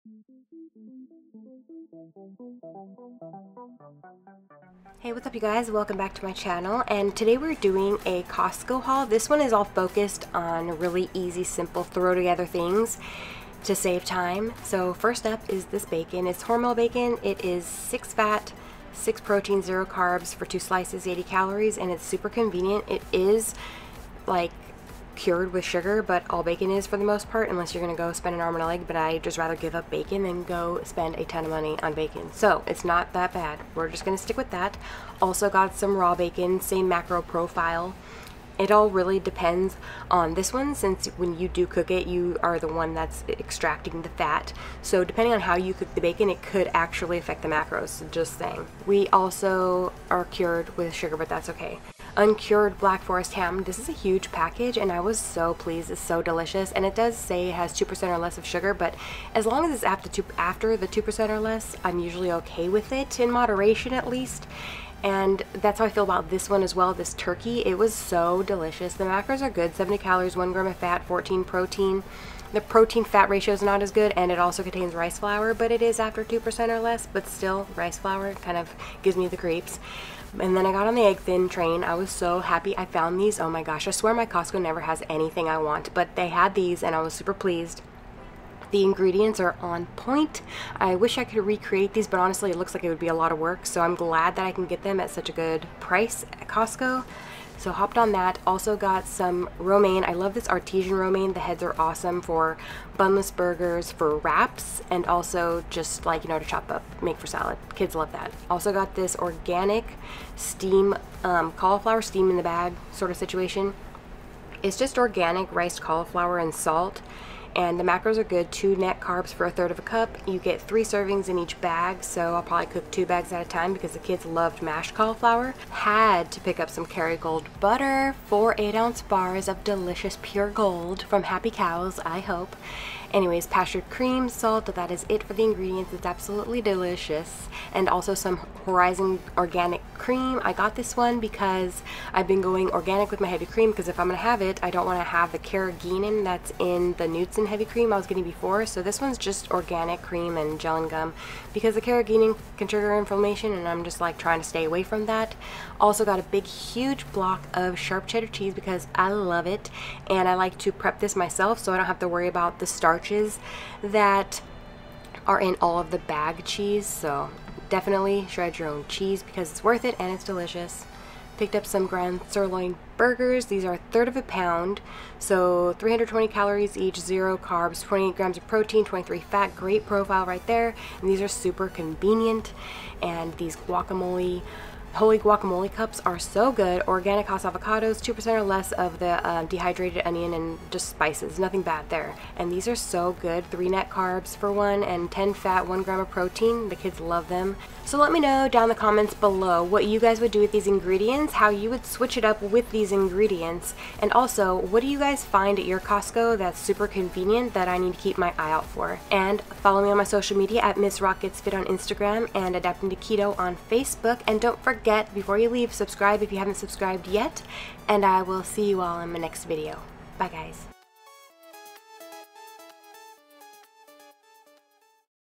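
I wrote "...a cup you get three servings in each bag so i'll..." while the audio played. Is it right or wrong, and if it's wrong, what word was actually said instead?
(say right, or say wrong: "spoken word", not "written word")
right.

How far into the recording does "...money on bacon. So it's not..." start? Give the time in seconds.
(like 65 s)
31 s.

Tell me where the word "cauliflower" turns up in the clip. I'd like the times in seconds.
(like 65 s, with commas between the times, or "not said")
111 s, 115 s, 124 s.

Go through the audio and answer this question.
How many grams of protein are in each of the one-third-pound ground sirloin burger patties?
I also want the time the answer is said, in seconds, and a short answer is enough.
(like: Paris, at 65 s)
28 grams, at 177 s.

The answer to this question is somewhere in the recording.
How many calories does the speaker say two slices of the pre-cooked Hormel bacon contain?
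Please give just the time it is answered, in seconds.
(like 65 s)
21 s.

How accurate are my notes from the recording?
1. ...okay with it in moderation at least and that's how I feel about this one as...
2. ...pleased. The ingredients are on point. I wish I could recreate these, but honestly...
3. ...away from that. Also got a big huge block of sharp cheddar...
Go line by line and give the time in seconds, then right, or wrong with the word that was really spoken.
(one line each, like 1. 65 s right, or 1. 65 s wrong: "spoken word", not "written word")
1. 62 s right
2. 87 s right
3. 154 s right.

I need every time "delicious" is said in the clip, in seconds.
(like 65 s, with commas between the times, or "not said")
56 s, 68 s, 129 s, 136 s, 170 s.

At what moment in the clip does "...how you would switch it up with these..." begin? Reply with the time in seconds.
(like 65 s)
201 s.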